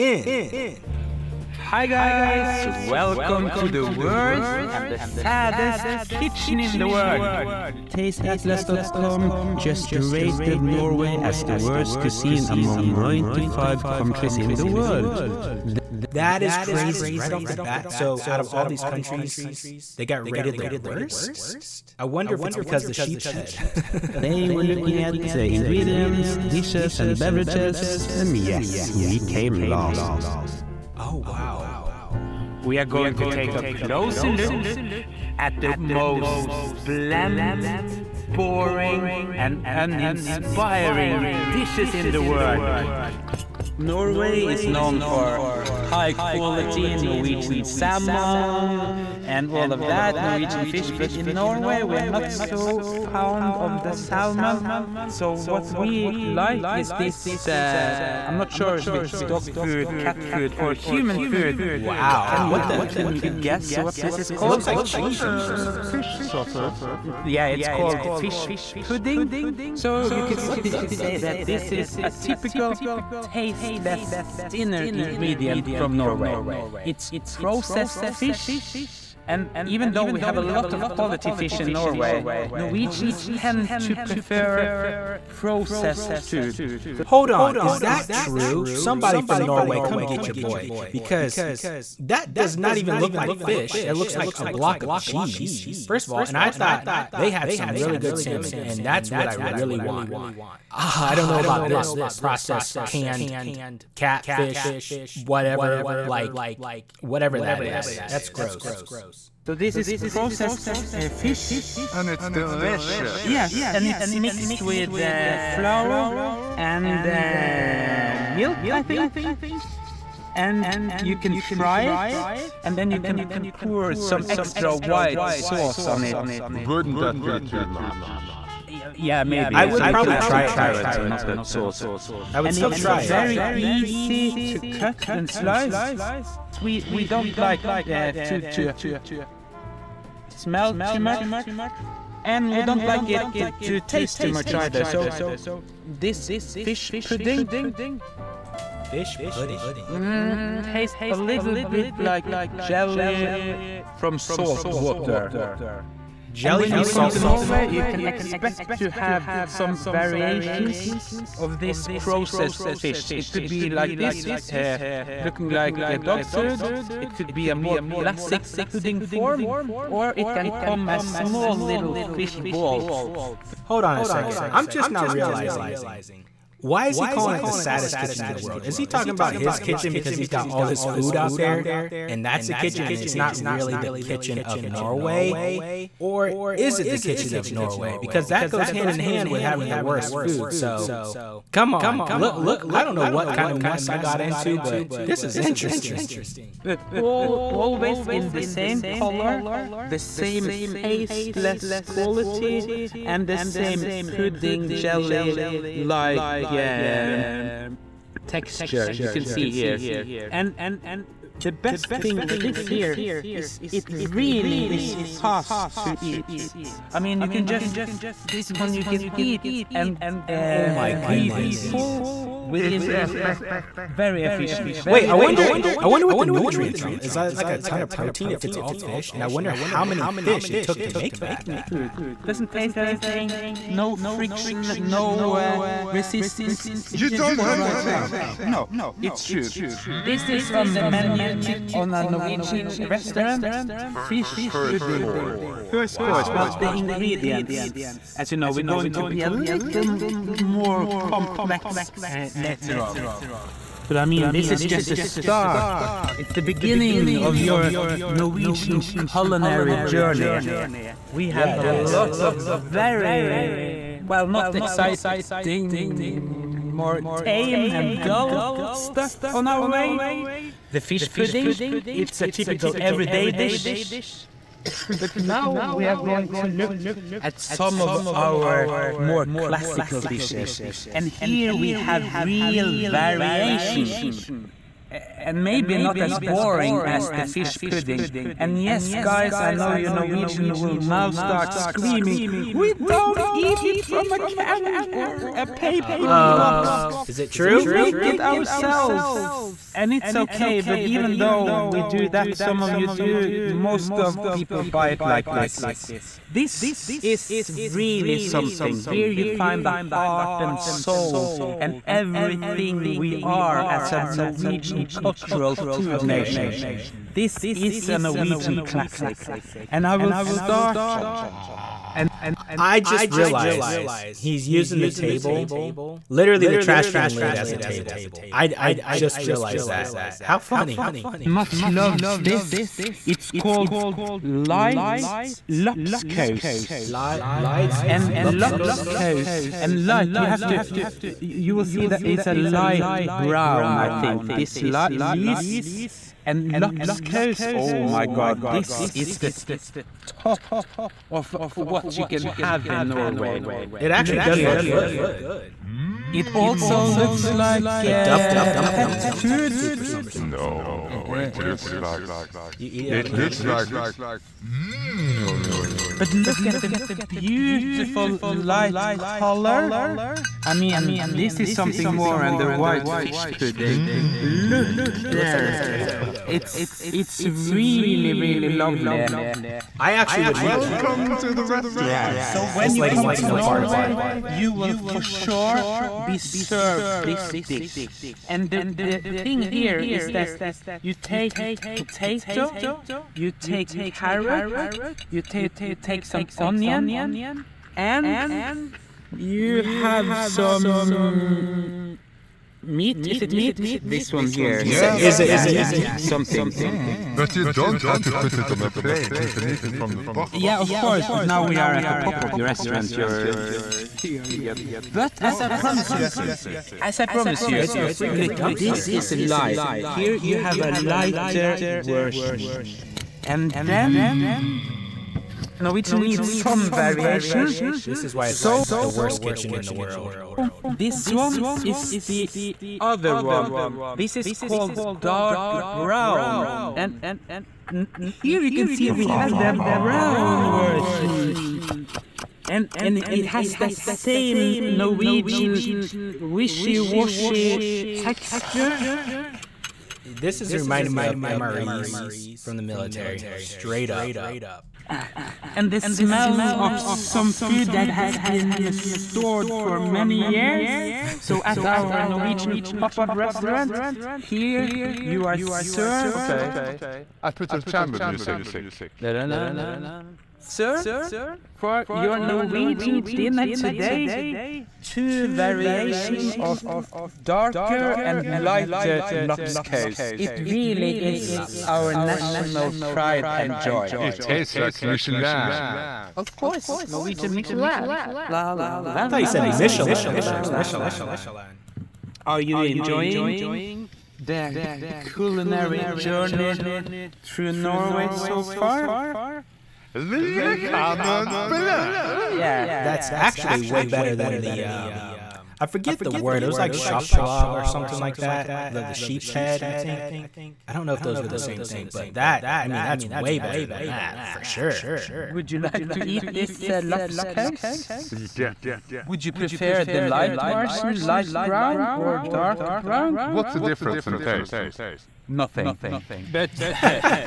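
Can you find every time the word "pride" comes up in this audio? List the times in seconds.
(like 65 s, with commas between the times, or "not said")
482 s.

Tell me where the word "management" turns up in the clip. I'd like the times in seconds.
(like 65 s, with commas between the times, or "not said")
not said.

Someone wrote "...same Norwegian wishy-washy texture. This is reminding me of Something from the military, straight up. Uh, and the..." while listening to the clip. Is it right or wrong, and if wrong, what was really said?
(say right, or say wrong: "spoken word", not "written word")
wrong: "MREs", not "Something".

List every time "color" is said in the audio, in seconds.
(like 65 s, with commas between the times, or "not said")
198 s, 368 s.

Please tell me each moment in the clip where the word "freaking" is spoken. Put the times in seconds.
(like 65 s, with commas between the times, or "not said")
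417 s.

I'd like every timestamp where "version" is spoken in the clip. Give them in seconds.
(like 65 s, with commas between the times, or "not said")
421 s, 440 s, 520 s.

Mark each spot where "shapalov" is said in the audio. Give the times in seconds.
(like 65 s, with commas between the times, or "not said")
506 s.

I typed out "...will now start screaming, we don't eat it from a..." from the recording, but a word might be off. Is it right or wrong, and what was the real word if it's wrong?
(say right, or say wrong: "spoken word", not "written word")
right.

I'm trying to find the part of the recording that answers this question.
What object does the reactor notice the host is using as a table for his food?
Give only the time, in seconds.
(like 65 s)
326 s.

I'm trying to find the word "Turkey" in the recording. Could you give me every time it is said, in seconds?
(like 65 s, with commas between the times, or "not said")
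not said.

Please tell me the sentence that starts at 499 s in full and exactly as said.
Leave Yeah, that's actually way better than the um, I forget the word.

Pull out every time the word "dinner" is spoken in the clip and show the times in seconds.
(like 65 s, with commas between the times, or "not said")
74 s, 473 s.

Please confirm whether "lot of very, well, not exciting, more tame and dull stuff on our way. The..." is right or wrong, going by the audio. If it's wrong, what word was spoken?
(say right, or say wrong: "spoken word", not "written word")
right.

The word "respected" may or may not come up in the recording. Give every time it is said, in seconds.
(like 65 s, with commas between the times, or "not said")
not said.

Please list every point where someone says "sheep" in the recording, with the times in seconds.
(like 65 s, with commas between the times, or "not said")
22 s, 508 s.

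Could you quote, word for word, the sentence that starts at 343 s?
I think this light lease and Lapskaus.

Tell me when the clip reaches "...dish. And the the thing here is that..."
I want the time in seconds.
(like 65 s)
387 s.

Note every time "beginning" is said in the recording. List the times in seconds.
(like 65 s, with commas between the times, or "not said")
256 s.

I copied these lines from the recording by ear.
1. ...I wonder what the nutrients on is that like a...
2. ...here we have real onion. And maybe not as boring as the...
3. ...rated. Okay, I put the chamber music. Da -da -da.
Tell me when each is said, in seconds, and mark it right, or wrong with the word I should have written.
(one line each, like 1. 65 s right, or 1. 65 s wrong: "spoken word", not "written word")
1. 225 s right
2. 281 s wrong: "variation", not "onion"
3. 465 s wrong: "served", not "rated".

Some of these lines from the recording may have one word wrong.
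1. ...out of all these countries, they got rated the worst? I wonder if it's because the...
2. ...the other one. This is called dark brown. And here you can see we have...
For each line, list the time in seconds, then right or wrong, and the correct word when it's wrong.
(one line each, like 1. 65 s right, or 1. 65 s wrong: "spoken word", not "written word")
1. 18 s right
2. 432 s right.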